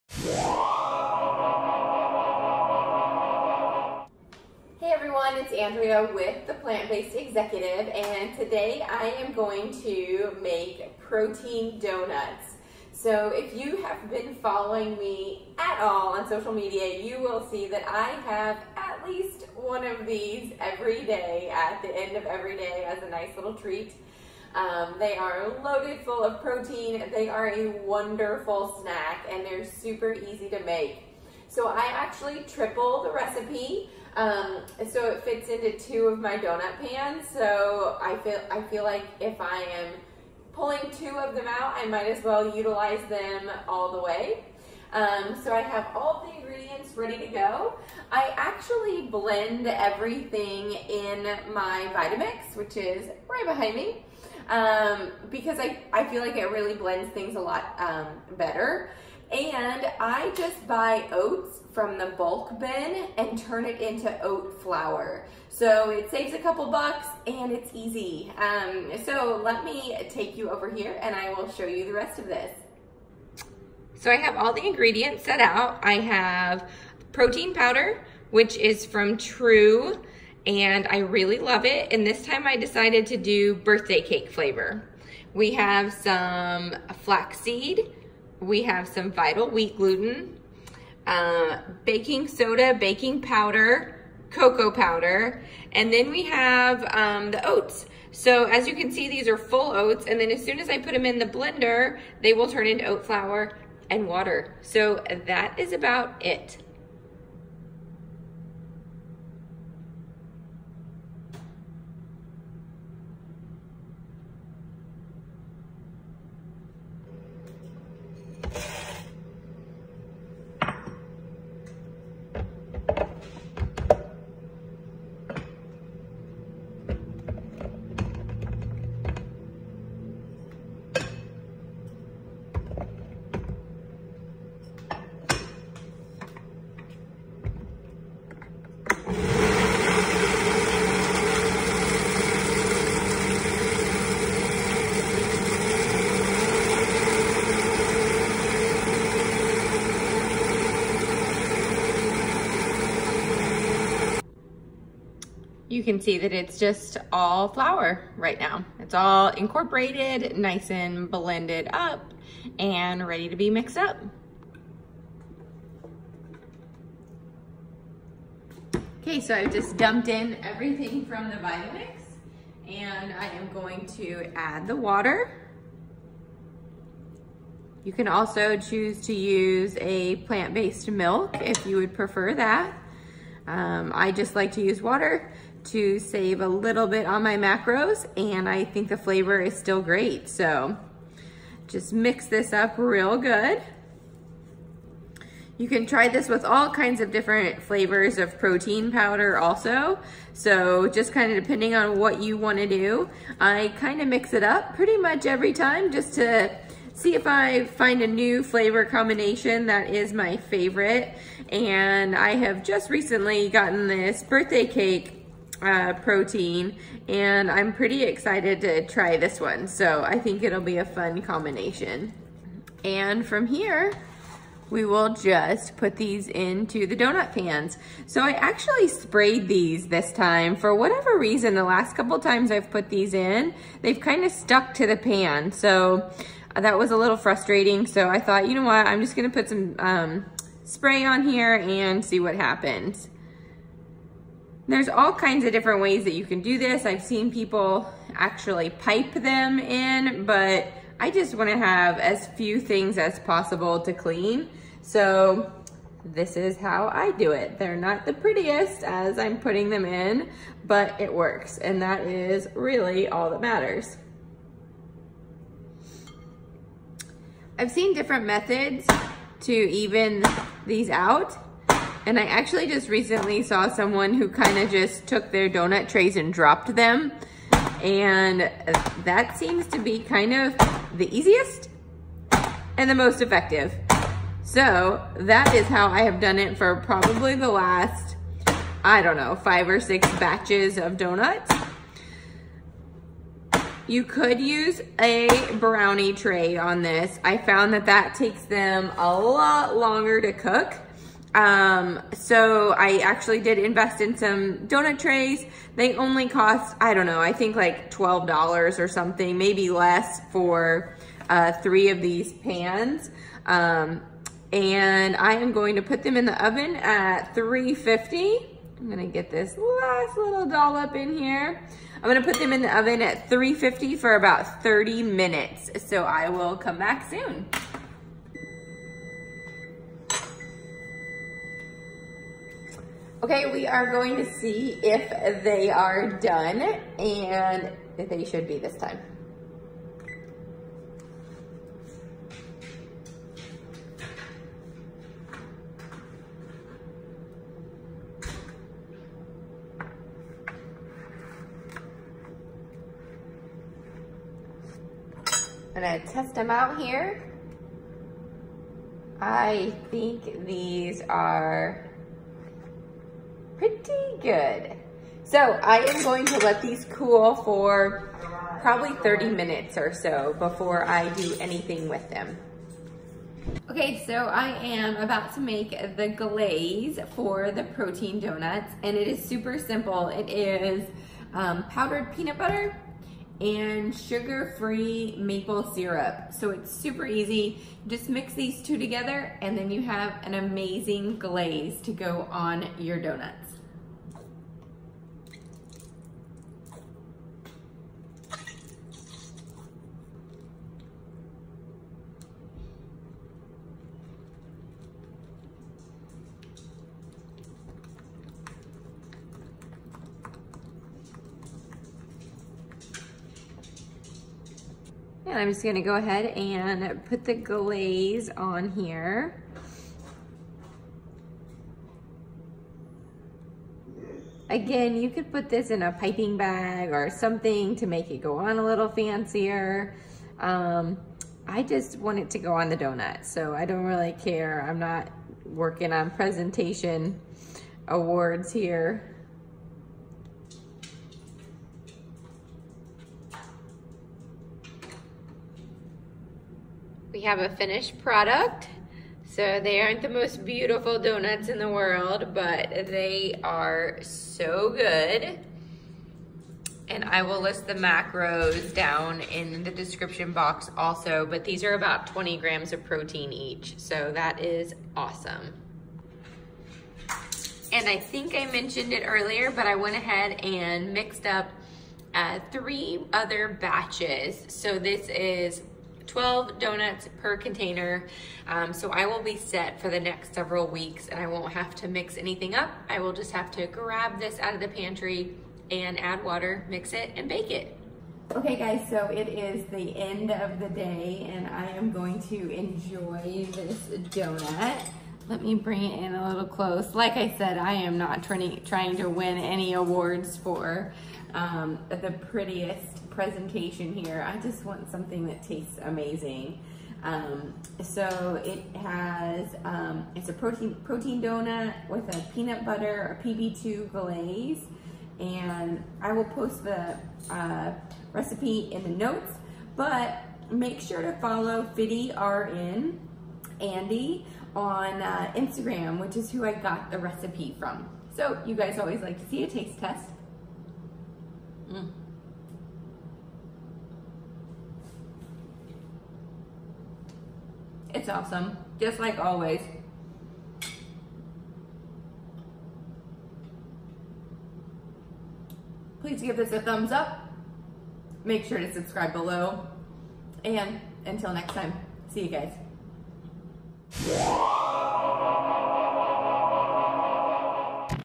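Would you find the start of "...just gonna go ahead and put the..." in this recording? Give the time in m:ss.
6:55.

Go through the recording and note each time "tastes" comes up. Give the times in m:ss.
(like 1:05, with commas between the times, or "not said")
8:25, 8:49.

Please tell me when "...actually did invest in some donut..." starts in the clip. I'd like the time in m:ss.
5:02.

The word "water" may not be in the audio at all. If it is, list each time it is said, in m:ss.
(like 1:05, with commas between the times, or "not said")
1:44, 2:54, 3:04, 8:06.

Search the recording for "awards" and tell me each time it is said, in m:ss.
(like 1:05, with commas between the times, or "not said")
7:17, 8:19.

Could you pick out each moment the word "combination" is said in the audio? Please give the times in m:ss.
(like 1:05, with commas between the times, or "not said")
3:28, 3:41.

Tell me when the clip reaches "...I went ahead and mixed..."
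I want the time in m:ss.
7:49.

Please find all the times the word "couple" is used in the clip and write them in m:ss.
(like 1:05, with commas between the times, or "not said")
1:06, 3:51.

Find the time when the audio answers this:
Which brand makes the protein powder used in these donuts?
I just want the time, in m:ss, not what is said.
1:19.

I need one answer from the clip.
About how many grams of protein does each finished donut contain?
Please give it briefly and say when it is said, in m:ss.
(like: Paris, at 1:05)
20 grams, at 7:42.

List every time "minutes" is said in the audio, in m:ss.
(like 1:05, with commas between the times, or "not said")
5:25, 6:09.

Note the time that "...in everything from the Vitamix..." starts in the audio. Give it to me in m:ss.
2:50.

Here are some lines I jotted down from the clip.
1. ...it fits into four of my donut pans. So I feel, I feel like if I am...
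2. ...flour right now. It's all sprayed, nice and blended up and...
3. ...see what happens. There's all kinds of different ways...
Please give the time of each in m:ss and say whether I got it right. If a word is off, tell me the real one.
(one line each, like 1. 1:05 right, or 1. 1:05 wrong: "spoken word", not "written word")
1. 0:35 wrong: "two", not "four"
2. 2:37 wrong: "incorporated", not "sprayed"
3. 4:02 right.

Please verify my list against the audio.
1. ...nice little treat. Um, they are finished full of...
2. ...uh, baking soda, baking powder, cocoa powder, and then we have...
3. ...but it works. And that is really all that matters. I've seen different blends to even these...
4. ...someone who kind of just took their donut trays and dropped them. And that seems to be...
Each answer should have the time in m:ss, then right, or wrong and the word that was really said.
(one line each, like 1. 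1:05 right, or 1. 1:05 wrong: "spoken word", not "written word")
1. 0:23 wrong: "loaded", not "finished"
2. 1:31 right
3. 4:20 wrong: "methods", not "blends"
4. 4:33 right.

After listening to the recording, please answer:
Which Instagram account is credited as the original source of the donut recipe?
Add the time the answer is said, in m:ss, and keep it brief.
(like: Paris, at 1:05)
RN Andy, at 8:41.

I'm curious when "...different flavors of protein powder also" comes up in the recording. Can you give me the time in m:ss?
3:17.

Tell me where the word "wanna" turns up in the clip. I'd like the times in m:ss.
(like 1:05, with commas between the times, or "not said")
4:11.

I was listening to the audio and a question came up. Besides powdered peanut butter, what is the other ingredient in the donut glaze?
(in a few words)
Sugar-free maple syrup.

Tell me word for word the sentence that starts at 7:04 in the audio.
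Again, you could put this in a piping bag or something to make it go on a little fancier.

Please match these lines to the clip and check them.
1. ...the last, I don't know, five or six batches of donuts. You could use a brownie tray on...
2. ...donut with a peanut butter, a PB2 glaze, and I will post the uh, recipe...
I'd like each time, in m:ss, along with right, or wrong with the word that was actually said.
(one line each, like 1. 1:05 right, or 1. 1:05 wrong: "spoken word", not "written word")
1. 4:47 right
2. 8:31 right.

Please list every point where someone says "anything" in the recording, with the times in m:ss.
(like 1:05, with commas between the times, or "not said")
6:11, 8:02.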